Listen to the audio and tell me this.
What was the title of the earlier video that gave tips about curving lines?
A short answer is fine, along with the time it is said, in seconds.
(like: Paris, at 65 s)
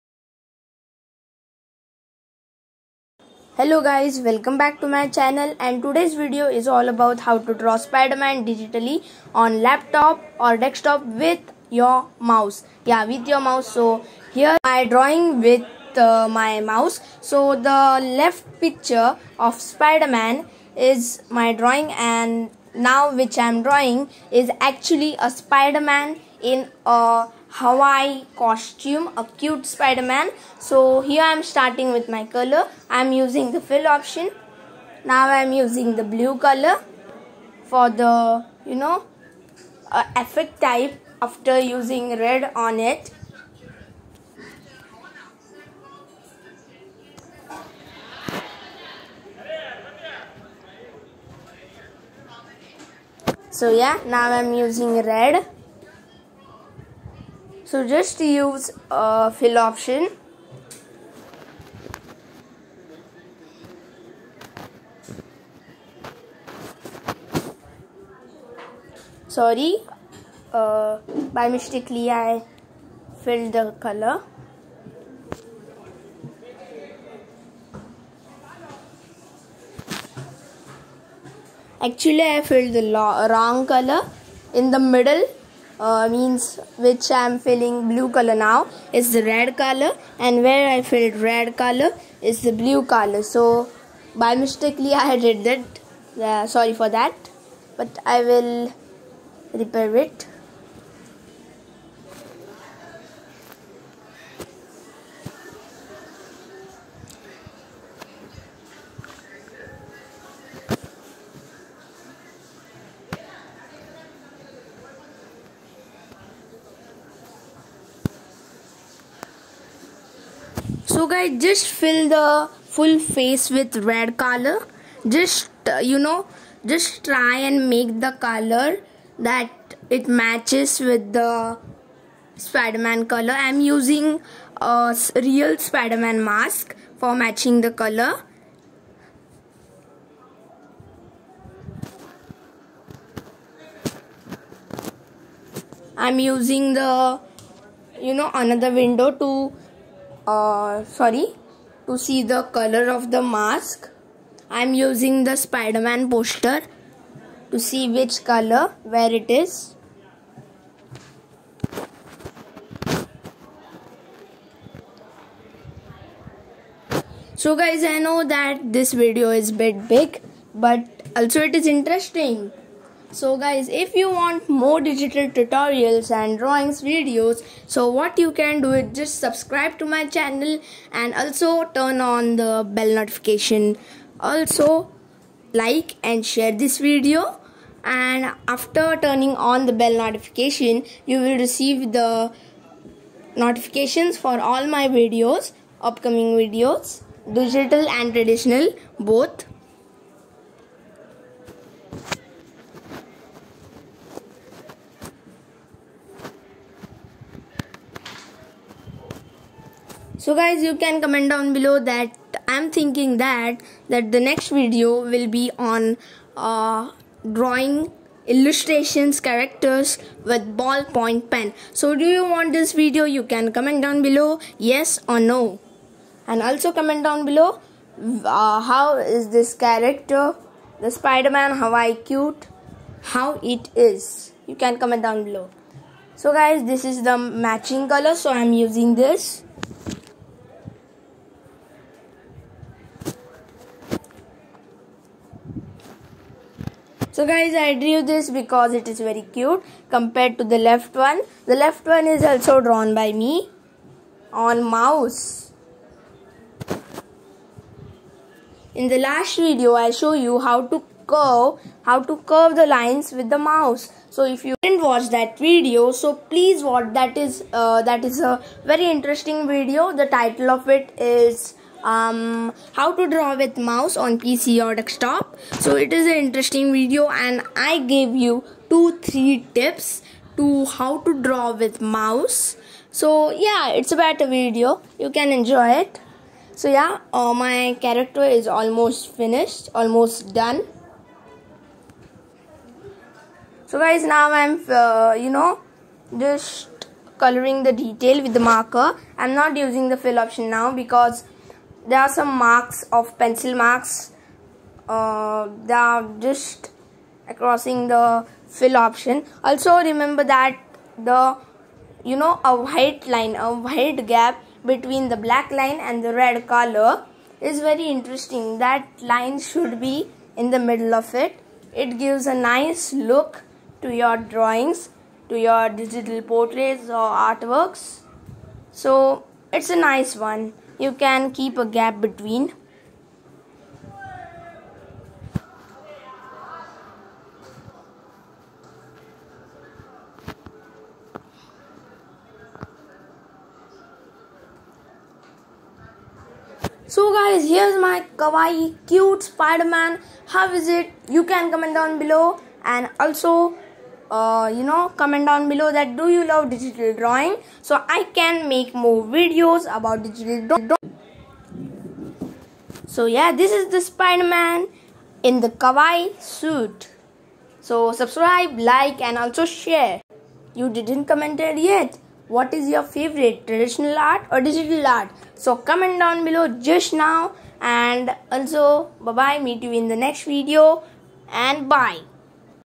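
How to draw with mouse on PC or desktop, at 272 s.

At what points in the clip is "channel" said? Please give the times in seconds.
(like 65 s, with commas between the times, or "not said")
5 s, 180 s.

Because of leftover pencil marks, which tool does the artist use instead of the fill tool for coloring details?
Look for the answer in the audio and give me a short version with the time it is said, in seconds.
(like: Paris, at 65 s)
Marker, at 298 s.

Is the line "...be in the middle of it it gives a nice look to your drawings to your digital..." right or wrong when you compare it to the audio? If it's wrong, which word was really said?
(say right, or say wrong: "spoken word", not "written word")
right.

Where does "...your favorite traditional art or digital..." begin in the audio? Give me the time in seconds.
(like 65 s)
372 s.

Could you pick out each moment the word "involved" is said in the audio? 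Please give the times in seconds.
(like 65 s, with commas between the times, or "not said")
not said.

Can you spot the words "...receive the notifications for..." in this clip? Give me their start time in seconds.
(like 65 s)
191 s.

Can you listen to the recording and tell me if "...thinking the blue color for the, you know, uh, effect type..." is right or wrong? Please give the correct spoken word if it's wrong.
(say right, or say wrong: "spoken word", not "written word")
wrong: "using", not "thinking".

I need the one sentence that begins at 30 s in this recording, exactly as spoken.
So here I am starting with my color.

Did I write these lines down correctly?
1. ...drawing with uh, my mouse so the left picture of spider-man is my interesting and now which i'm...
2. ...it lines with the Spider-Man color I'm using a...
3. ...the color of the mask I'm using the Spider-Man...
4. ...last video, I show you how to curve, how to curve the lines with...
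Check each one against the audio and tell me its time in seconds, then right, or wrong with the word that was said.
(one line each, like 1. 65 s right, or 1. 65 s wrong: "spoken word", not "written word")
1. 14 s wrong: "drawing", not "interesting"
2. 129 s wrong: "matches", not "lines"
3. 152 s right
4. 258 s right.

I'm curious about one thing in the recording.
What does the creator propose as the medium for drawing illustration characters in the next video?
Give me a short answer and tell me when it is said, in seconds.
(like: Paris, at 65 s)
Ballpoint pen, at 220 s.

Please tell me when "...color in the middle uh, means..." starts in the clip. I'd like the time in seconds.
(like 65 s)
83 s.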